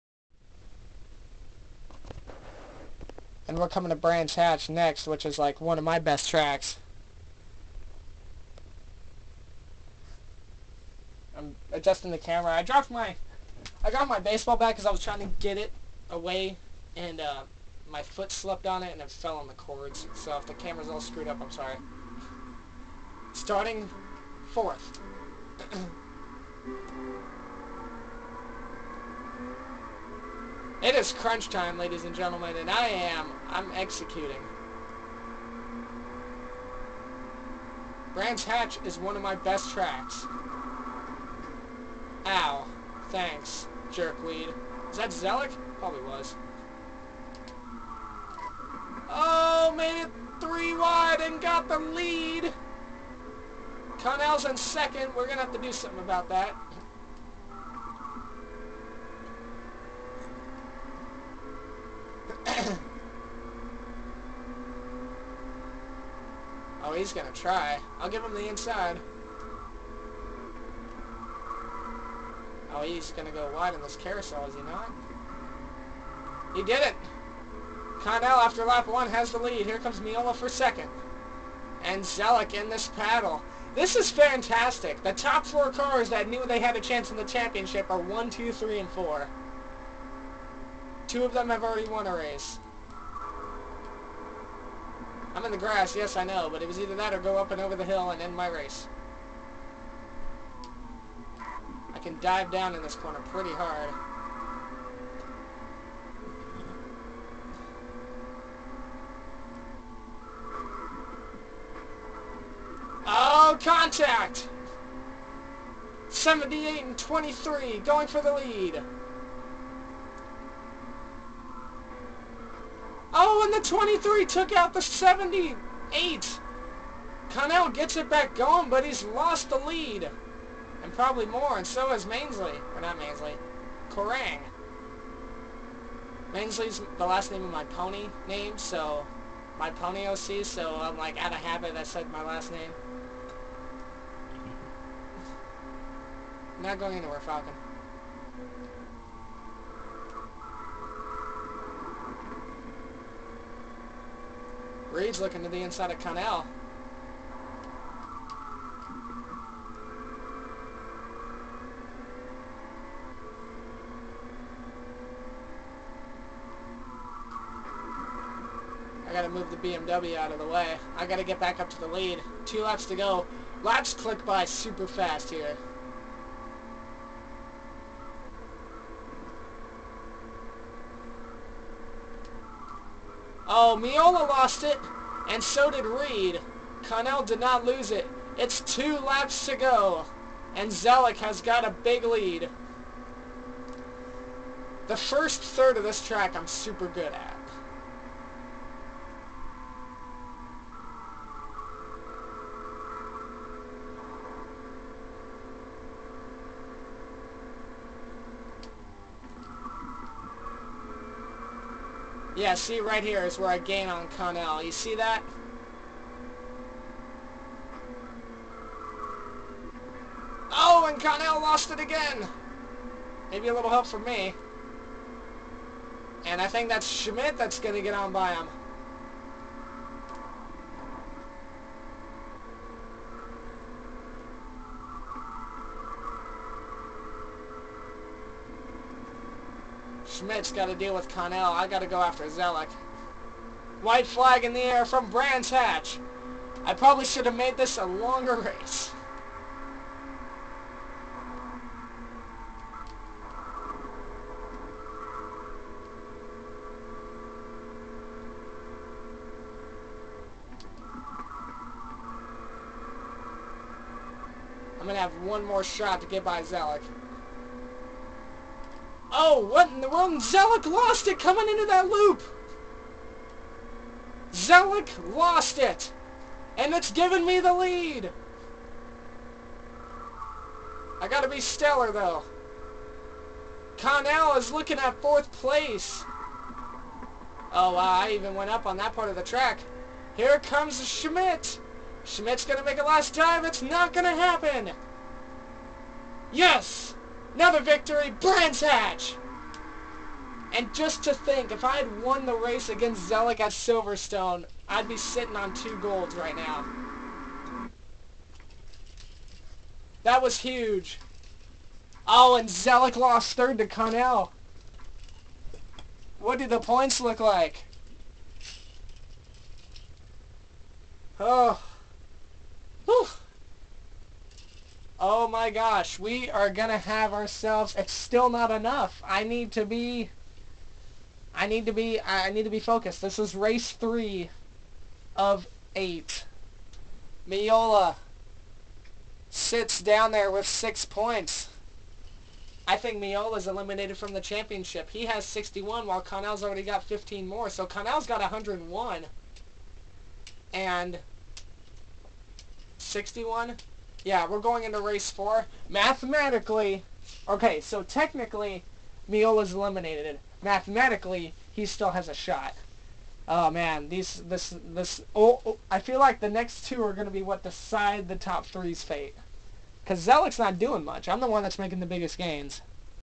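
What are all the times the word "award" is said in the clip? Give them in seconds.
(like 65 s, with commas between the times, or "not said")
not said.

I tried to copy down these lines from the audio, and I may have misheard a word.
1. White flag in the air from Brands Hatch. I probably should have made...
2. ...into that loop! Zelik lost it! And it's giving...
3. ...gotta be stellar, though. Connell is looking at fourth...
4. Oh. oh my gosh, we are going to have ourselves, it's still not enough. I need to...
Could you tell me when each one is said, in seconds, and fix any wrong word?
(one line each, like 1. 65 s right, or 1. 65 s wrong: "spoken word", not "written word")
1. 243 s right
2. 271 s right
3. 281 s right
4. 321 s right.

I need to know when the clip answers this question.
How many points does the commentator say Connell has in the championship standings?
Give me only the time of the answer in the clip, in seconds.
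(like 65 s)
347 s.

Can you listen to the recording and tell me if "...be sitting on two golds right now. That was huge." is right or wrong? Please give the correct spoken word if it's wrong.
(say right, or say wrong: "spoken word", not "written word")
right.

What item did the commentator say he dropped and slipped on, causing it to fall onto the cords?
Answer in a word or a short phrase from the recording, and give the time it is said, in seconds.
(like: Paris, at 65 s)
baseball bat, at 14 s.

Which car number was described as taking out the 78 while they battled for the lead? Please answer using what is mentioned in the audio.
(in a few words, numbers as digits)
23.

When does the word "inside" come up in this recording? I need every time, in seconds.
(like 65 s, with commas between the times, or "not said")
68 s, 155 s.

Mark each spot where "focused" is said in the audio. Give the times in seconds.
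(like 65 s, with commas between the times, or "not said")
332 s.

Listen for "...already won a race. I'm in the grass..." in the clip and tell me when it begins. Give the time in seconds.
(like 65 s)
91 s.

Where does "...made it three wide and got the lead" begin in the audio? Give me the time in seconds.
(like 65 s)
49 s.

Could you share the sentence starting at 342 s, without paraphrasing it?
I think Miola's eliminated from the championship.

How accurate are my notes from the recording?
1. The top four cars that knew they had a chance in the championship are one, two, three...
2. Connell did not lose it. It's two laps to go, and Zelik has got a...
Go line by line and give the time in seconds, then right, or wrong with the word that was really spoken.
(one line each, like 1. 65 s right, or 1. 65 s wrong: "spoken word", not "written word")
1. 85 s right
2. 186 s right.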